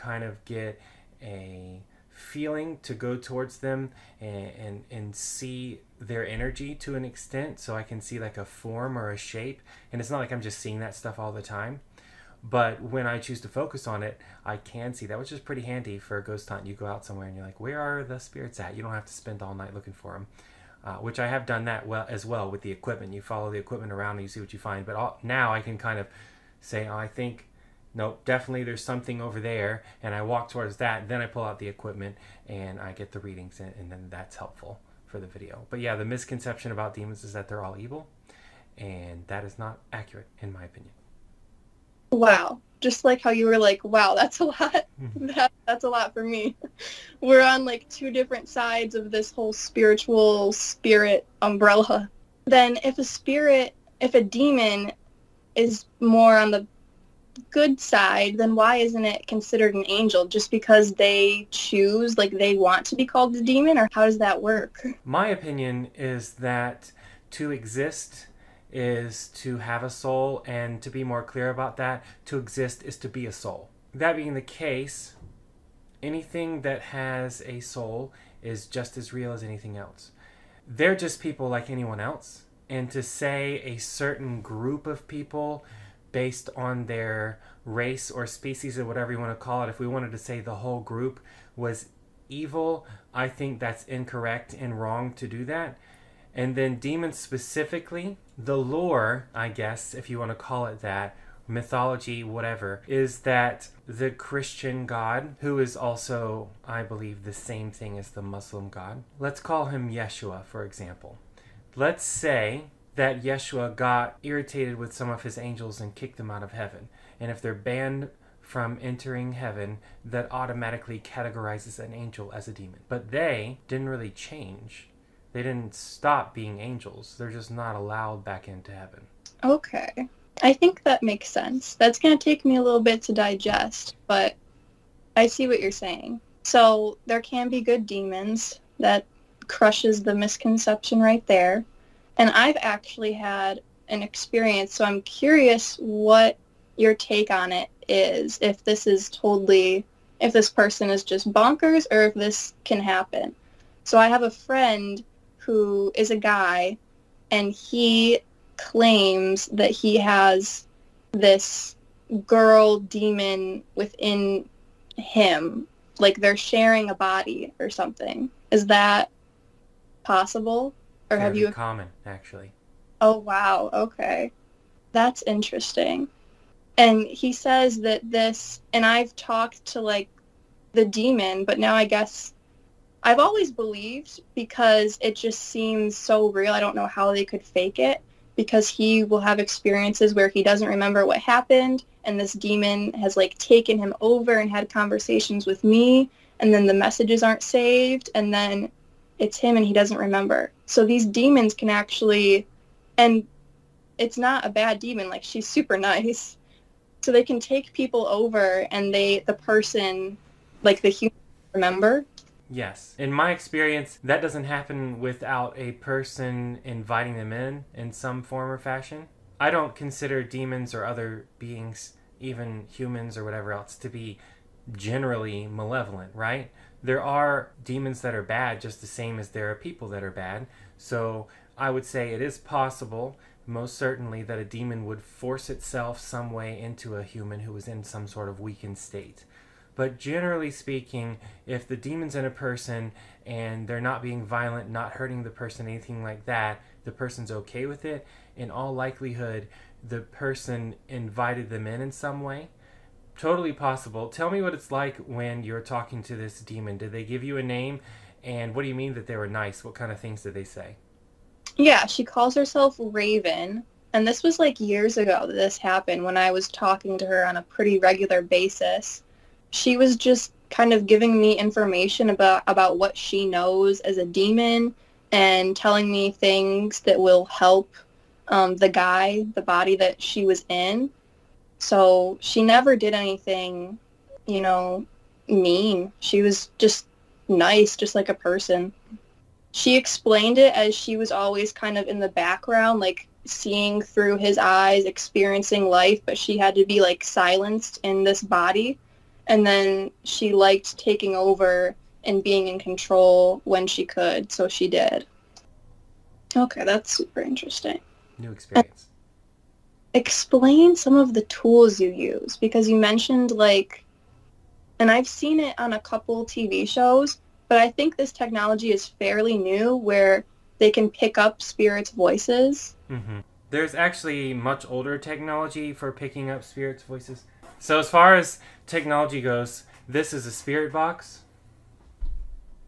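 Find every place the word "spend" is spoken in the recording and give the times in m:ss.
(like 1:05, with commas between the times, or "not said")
0:19.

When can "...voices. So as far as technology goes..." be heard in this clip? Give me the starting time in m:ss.
5:26.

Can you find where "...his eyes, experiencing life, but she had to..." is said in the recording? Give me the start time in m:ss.
4:54.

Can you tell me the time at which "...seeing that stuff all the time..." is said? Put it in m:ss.
0:10.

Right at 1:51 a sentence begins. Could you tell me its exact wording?
Let's say that Yeshua got irritated with some of his angels and kicked them out of heaven.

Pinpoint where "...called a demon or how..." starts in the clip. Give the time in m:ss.
1:03.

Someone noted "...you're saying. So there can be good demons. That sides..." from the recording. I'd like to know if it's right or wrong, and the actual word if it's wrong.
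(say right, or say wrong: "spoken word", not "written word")
wrong: "crushes", not "sides".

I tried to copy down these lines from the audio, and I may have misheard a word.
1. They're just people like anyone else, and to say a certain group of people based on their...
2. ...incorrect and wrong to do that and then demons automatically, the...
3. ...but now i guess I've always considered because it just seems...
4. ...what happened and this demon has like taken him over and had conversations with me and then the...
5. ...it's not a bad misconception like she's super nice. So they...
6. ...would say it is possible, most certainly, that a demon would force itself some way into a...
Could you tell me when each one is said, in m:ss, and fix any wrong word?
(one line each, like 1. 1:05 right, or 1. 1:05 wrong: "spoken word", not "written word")
1. 1:20 right
2. 1:33 wrong: "specifically", not "automatically"
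3. 3:01 wrong: "believed", not "considered"
4. 3:11 right
5. 3:23 wrong: "demon", not "misconception"
6. 3:51 right.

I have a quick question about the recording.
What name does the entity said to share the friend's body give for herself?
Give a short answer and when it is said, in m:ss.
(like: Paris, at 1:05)
Raven, at 4:22.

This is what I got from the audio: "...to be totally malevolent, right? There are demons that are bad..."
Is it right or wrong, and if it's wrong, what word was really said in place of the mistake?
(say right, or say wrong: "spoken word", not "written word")
wrong: "generally", not "totally".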